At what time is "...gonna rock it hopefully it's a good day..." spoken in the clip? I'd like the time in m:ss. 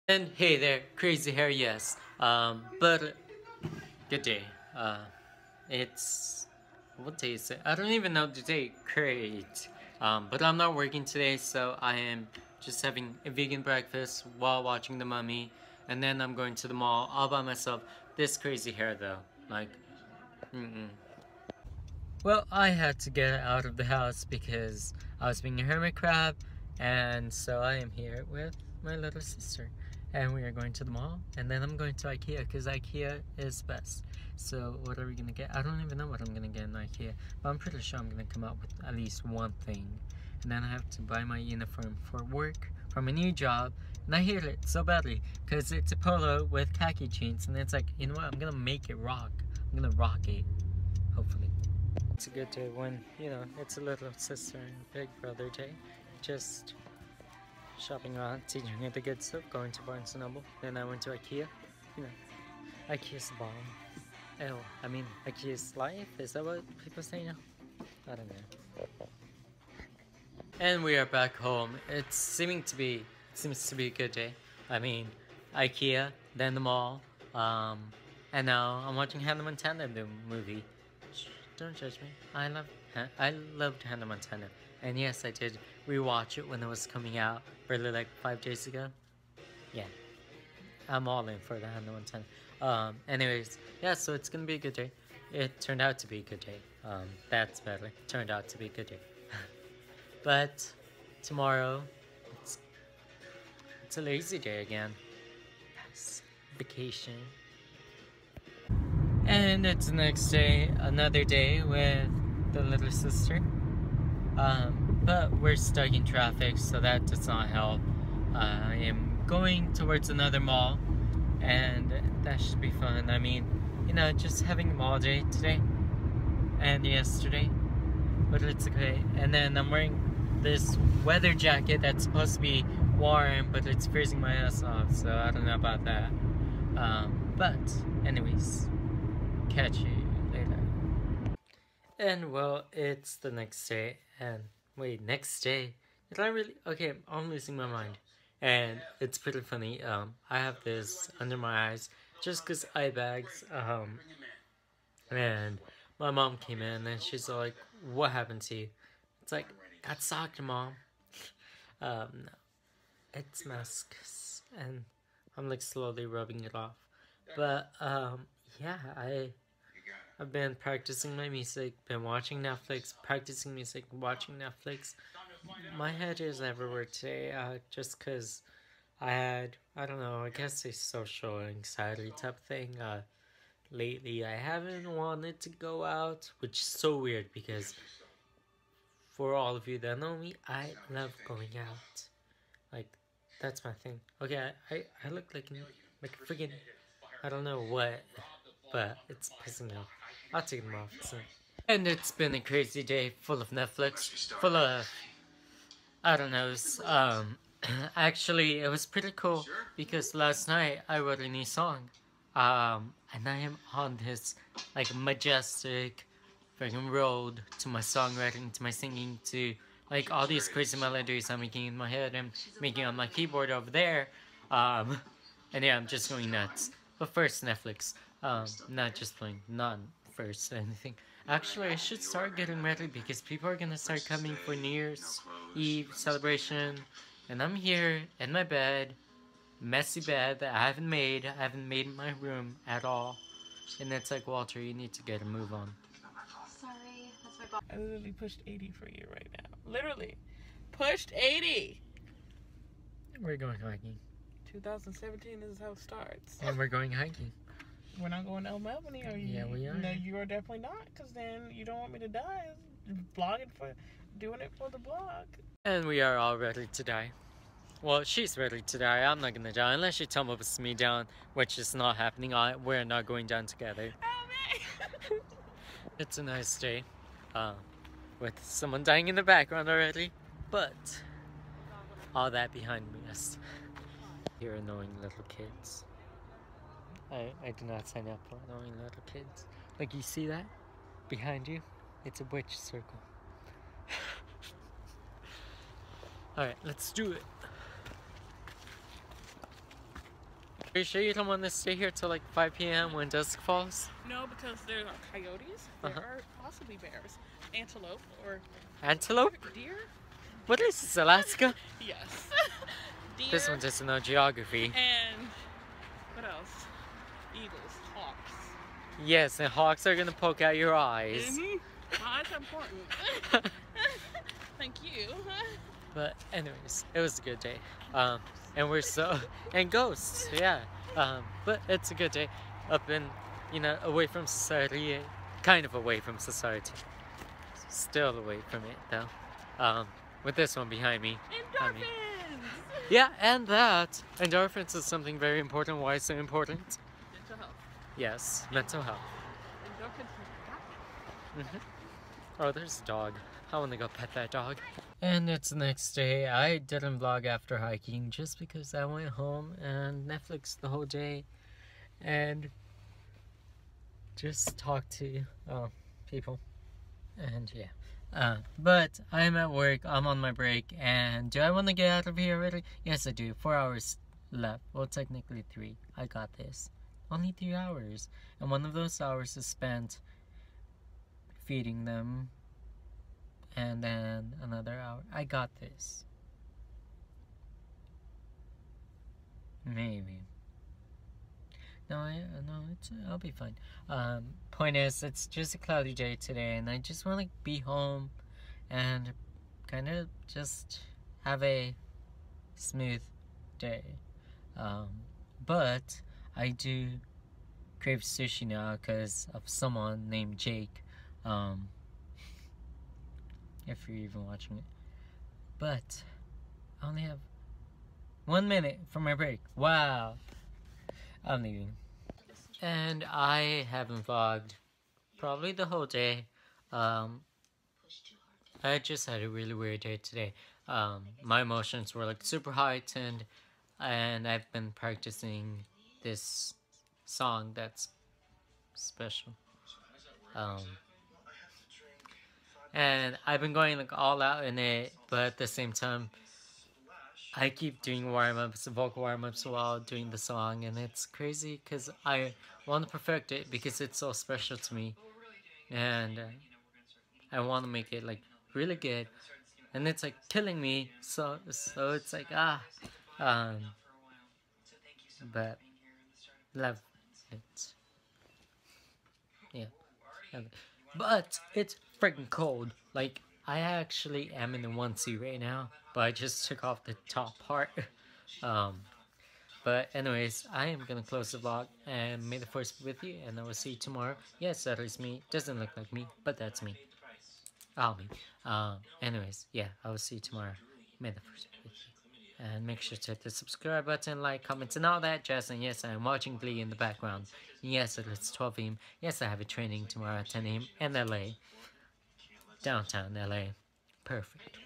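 0:49.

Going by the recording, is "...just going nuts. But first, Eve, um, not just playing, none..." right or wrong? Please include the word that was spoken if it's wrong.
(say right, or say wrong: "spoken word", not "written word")
wrong: "Netflix", not "Eve".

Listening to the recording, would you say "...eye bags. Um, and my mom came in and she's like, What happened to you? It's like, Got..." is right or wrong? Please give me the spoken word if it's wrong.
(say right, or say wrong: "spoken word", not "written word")
right.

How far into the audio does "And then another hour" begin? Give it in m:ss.
6:23.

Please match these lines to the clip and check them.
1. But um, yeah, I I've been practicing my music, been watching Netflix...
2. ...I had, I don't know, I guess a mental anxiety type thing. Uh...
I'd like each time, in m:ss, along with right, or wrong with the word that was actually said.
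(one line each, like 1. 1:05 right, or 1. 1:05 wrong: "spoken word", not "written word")
1. 2:47 right
2. 2:58 wrong: "social", not "mental".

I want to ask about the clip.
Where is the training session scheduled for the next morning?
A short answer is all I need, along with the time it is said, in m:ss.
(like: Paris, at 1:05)
Downtown LA, at 8:22.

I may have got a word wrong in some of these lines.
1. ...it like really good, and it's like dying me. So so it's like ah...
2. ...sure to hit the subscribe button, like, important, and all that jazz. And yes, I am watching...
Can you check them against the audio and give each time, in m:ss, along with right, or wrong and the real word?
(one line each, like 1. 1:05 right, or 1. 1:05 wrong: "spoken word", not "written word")
1. 7:37 wrong: "killing", not "dying"
2. 8:12 wrong: "comment", not "important".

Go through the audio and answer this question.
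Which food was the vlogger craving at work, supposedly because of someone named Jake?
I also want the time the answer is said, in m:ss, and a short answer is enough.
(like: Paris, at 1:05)
Sushi, at 6:48.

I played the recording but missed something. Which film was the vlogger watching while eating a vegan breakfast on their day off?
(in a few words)
The Mummy.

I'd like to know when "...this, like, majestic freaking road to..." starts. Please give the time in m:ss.
3:34.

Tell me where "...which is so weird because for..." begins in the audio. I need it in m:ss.
3:06.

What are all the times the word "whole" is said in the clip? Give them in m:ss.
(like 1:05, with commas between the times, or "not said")
6:00, 7:05.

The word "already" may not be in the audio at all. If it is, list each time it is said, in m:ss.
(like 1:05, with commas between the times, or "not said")
4:39, 6:12.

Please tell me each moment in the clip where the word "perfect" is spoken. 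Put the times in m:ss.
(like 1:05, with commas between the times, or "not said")
7:32, 8:24.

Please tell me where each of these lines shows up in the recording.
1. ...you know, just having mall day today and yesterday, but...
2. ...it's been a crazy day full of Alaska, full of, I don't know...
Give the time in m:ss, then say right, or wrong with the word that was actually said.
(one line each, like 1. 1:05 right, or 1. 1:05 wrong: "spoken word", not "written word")
1. 2:03 right
2. 3:21 wrong: "Netflix", not "Alaska".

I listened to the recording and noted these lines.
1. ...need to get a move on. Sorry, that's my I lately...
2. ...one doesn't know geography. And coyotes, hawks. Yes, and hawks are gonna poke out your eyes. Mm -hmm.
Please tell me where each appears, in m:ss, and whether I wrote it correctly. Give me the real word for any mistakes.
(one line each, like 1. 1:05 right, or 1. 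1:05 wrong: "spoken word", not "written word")
1. 4:04 wrong: "literally", not "lately"
2. 5:13 wrong: "eagles", not "coyotes".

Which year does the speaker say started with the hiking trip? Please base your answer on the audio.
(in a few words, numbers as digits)
2017.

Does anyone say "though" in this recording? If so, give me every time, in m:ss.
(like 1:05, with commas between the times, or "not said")
0:18, 5:38.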